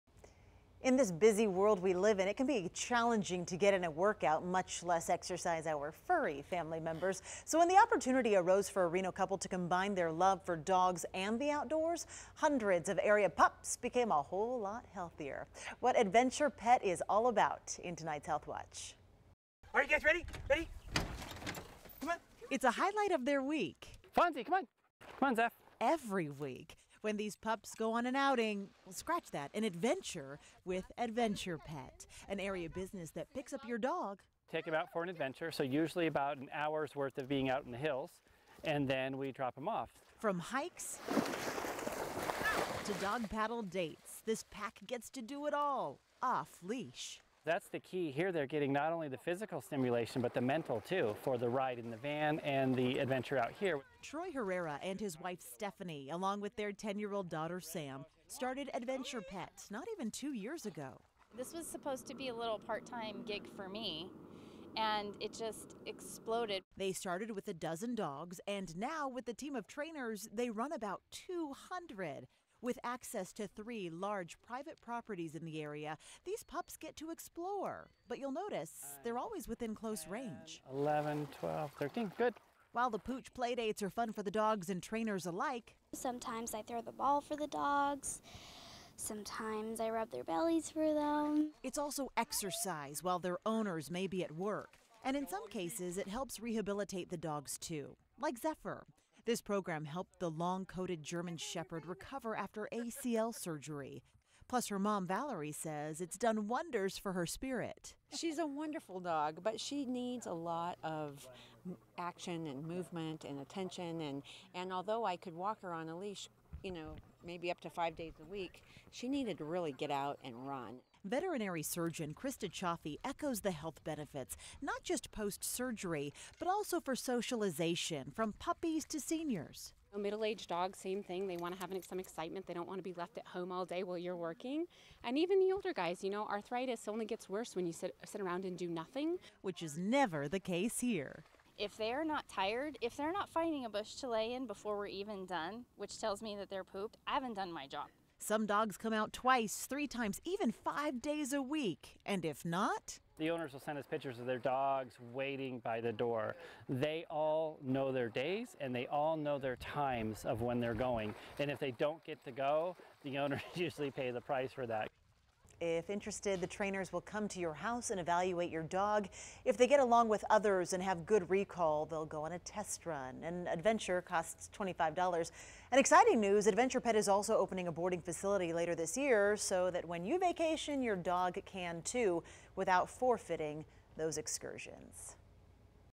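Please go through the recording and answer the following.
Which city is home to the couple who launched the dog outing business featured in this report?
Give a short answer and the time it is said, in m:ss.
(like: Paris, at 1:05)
Reno, at 0:08.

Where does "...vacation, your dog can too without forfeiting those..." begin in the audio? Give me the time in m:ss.
3:00.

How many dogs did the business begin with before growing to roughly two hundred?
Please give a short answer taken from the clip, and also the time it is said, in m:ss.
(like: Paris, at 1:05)
12, at 1:07.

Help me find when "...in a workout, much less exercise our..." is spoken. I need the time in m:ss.
0:03.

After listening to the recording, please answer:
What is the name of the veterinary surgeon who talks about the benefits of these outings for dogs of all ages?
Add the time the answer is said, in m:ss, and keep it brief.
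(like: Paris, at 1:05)
Krista Chaffee, at 2:02.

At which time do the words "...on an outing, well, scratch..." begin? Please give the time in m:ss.
0:27.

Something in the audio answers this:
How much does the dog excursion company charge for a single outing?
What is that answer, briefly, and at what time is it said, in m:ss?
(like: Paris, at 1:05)
$25, at 2:54.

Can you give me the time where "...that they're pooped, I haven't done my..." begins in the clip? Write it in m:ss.
2:26.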